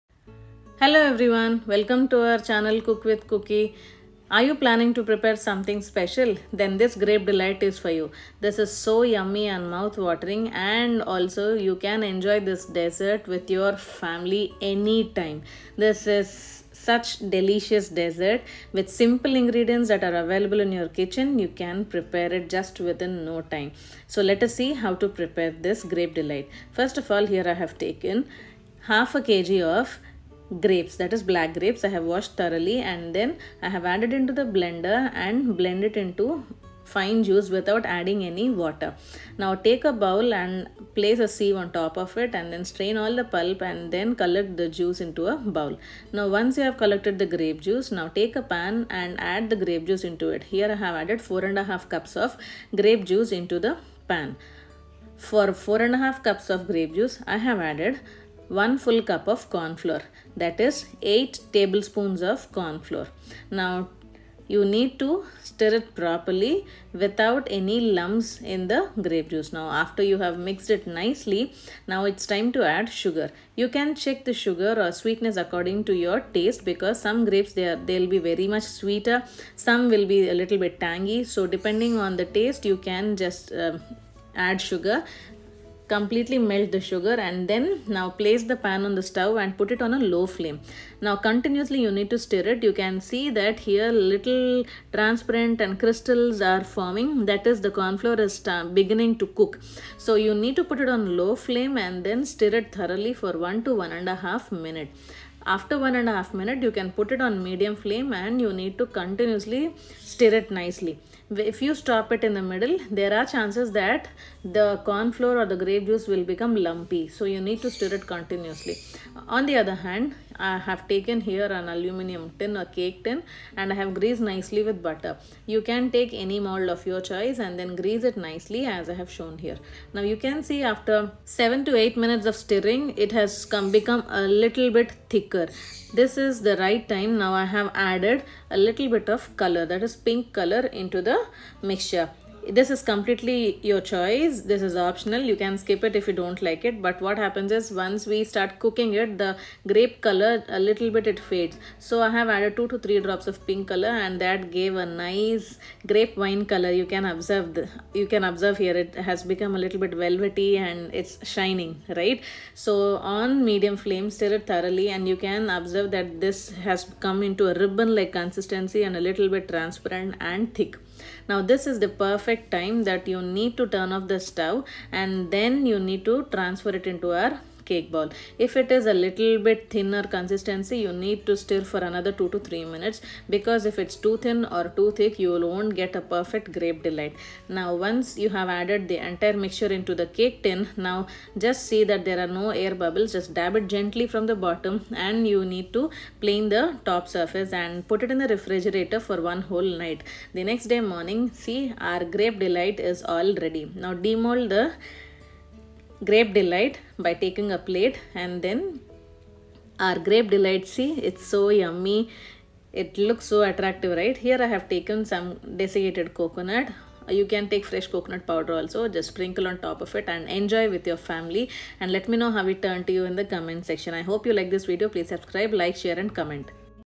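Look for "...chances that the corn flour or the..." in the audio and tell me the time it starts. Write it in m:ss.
1:53.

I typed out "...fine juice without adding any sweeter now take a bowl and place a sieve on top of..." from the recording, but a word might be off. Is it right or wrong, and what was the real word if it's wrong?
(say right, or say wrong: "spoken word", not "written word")
wrong: "water", not "sweeter".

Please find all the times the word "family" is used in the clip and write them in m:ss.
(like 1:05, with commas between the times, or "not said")
0:13, 3:40.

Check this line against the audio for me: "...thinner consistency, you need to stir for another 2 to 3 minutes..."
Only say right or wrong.
right.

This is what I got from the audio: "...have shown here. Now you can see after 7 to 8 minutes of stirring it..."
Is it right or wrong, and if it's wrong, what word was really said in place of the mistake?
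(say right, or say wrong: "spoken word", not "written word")
right.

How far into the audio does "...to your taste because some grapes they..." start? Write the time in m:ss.
1:15.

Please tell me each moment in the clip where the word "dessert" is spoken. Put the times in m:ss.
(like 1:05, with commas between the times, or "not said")
0:12, 0:17.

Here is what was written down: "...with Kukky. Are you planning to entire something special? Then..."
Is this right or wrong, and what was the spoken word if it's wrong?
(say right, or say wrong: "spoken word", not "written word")
wrong: "prepare", not "entire".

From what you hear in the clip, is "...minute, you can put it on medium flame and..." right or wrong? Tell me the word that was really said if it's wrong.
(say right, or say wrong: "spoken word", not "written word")
right.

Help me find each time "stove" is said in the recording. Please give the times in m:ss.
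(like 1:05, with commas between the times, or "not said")
1:29, 2:54.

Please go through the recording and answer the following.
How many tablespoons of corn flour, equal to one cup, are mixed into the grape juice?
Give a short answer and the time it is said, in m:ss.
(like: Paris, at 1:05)
8, at 1:01.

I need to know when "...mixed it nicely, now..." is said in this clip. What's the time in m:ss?
1:10.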